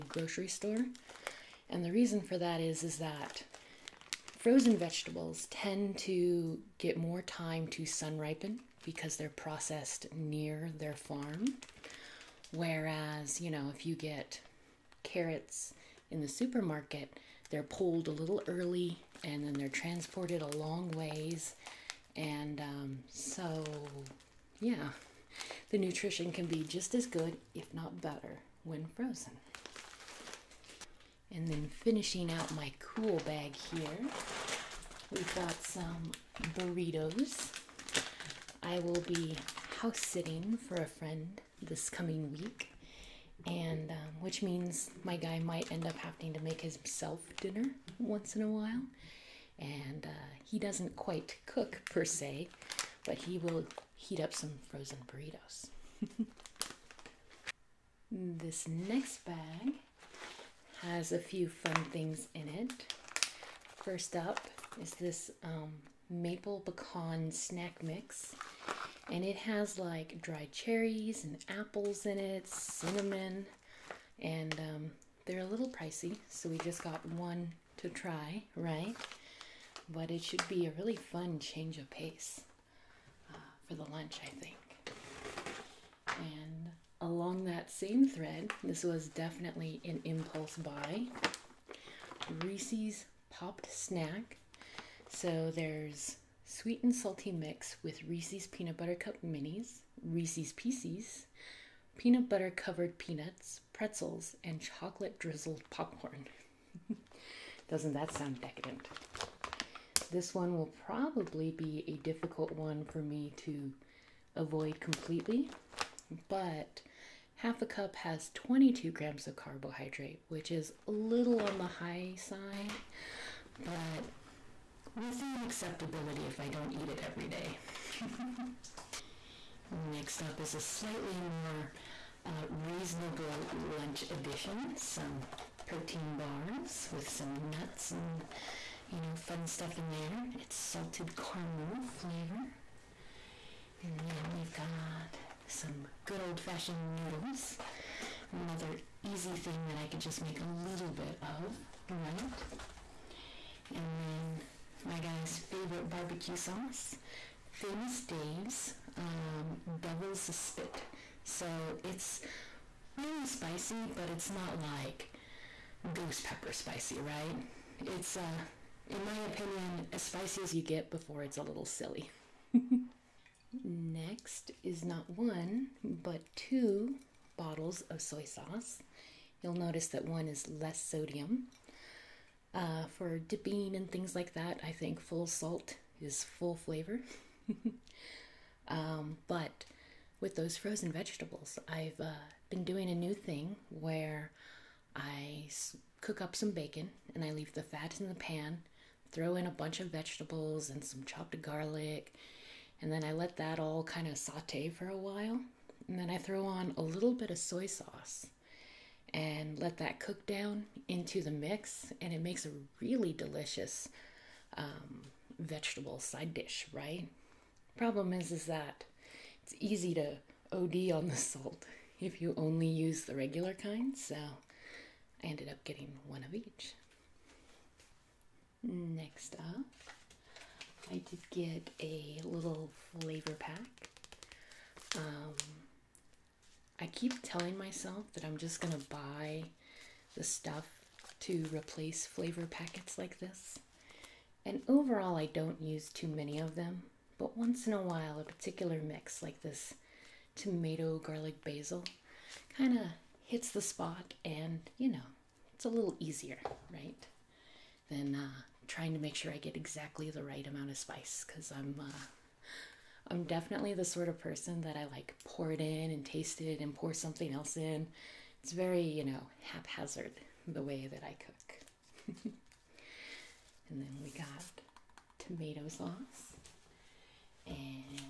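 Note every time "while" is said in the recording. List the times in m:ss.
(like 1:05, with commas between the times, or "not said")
0:48, 3:24, 4:07.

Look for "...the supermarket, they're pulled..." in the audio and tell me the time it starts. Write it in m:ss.
0:16.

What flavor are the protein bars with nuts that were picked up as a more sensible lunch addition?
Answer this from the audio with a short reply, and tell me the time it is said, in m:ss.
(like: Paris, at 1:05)
Salted caramel, at 2:20.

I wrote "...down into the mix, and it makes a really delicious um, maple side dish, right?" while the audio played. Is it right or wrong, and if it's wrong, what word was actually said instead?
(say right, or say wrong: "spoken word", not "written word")
wrong: "vegetable", not "maple".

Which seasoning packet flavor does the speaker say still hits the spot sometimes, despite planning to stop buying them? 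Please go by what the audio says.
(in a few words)
Tomato garlic basil.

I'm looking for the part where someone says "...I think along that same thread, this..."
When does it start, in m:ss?
1:24.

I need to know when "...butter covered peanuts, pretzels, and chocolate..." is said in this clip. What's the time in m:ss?
1:42.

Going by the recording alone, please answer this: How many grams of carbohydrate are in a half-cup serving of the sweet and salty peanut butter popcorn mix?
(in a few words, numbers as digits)
22.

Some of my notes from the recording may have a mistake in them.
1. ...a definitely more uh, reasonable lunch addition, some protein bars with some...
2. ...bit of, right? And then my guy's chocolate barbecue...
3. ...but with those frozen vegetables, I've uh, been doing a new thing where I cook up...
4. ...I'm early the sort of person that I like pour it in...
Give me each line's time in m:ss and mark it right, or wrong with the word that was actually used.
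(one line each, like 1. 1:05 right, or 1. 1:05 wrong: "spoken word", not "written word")
1. 2:10 wrong: "slightly", not "definitely"
2. 2:30 wrong: "favorite", not "chocolate"
3. 3:09 right
4. 4:23 wrong: "definitely", not "early".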